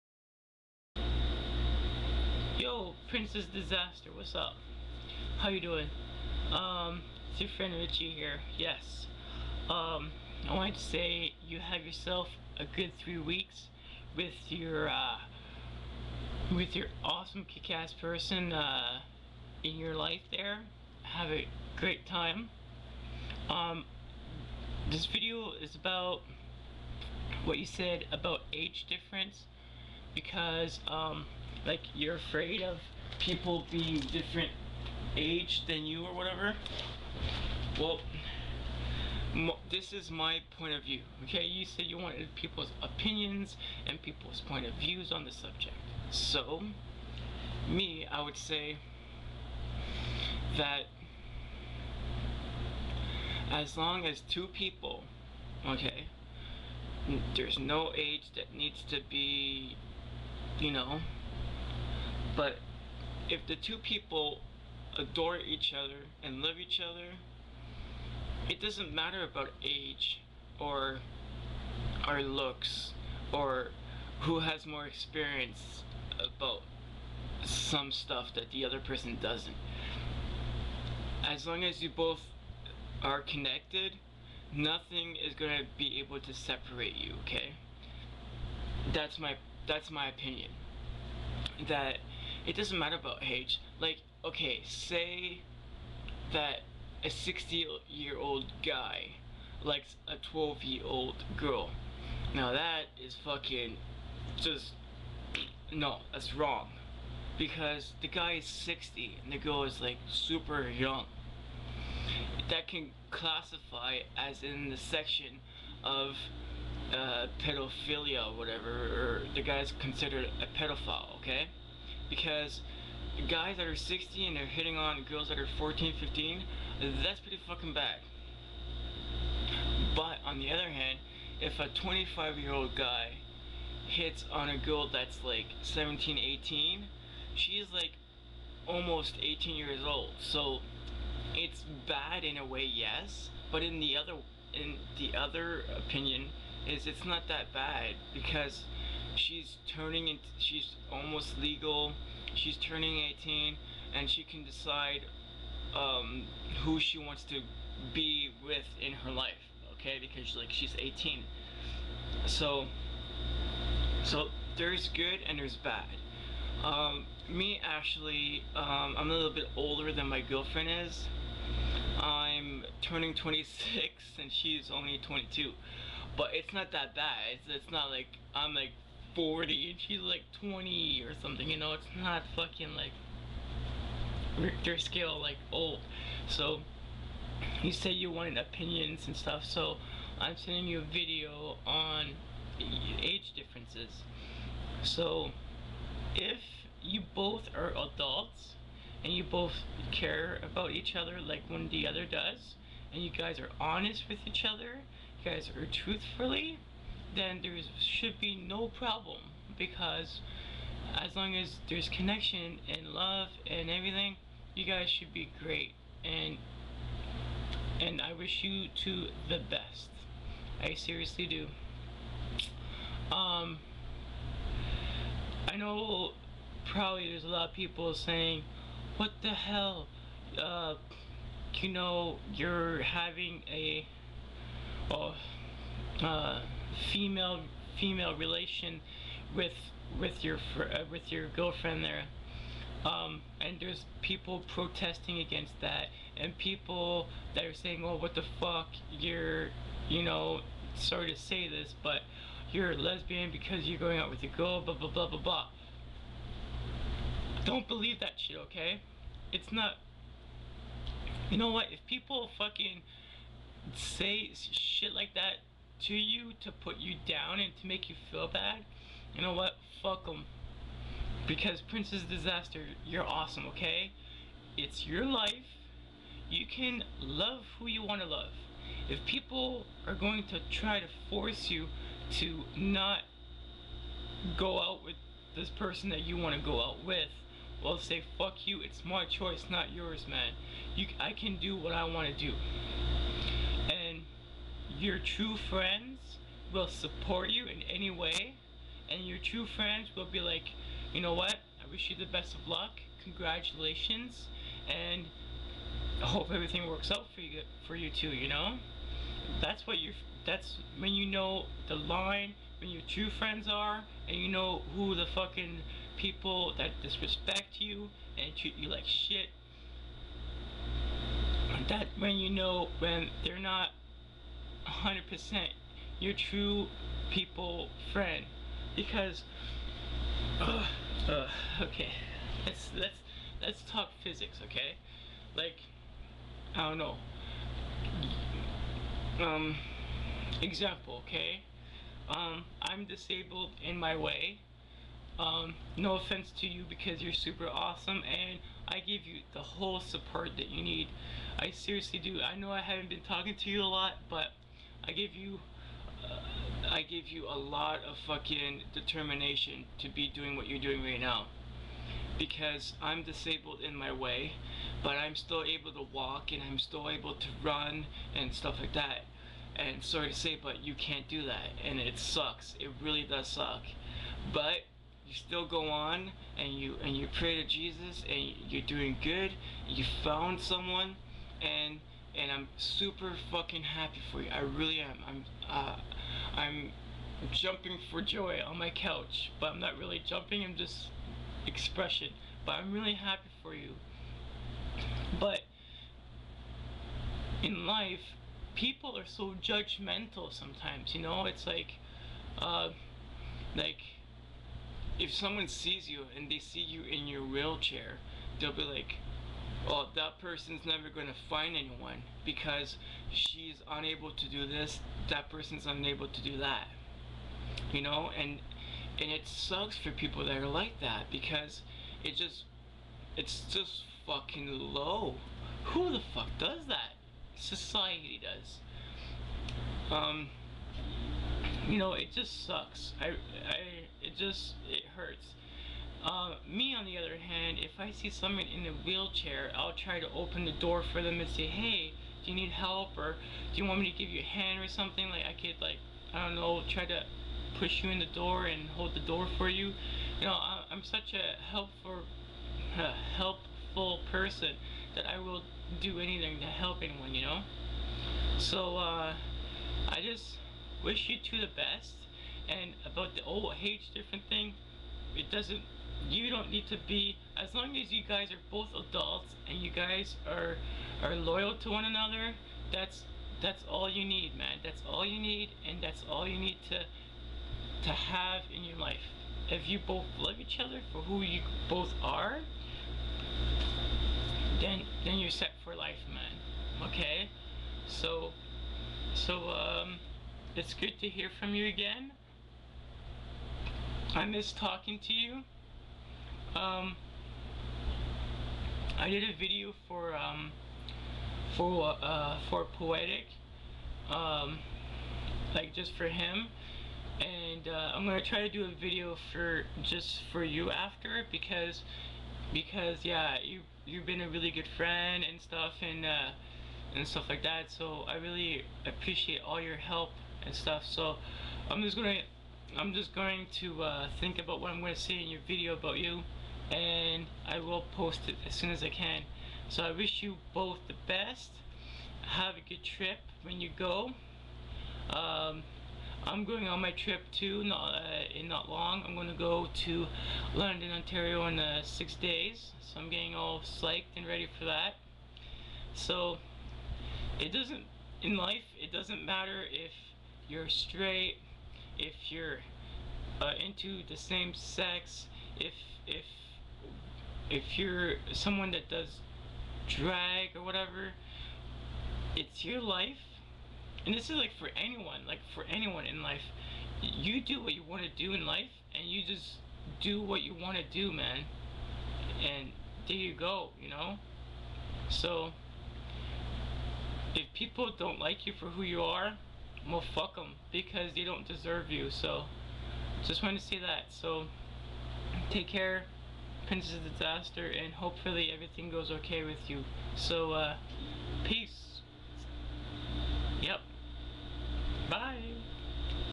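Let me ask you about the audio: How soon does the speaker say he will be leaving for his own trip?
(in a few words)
6 days.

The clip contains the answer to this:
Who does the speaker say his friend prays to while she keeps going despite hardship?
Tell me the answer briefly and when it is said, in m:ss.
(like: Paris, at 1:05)
Jesus, at 6:17.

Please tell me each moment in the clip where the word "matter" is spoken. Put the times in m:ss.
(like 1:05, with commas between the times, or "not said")
1:08, 1:32, 9:09.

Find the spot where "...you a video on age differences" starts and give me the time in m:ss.
3:10.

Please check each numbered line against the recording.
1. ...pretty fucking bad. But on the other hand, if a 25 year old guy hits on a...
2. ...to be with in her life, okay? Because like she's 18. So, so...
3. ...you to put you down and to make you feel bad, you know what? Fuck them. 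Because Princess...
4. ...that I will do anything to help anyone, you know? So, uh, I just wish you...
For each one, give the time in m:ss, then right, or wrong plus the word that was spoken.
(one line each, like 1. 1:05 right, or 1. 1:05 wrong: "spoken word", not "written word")
1. 2:07 right
2. 2:37 right
3. 4:25 right
4. 7:34 right.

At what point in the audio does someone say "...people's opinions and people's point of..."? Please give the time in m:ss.
0:42.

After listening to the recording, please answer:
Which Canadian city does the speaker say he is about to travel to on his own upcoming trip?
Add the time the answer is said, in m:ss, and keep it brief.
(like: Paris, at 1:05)
London, Ontario, at 9:00.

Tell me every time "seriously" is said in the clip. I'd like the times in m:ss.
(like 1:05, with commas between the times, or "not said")
3:40, 5:51.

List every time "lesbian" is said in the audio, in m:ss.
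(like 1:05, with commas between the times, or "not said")
4:12.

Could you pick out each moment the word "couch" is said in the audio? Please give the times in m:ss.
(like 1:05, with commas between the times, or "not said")
6:28.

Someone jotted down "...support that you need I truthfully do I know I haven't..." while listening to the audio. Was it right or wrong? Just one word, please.
wrong.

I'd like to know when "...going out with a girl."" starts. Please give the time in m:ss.
4:13.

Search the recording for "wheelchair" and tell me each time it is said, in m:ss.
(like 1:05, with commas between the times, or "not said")
6:47, 7:18.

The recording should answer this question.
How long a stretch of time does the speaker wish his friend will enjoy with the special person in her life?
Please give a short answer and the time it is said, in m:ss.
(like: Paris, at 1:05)
3 weeks, at 0:13.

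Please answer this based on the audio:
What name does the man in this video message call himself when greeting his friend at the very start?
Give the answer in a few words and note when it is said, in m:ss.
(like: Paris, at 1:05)
Richie, at 0:07.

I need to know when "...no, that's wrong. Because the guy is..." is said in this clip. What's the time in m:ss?
1:45.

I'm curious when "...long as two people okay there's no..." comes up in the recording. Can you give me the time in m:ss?
0:53.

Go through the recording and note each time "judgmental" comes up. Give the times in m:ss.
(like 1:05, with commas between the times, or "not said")
6:39.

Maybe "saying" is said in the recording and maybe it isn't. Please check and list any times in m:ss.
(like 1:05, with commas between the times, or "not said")
3:47, 4:07.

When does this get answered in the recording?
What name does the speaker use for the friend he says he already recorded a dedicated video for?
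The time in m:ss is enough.
8:22.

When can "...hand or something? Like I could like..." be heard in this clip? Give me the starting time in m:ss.
7:24.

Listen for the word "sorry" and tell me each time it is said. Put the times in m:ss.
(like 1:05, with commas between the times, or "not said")
4:10, 6:09.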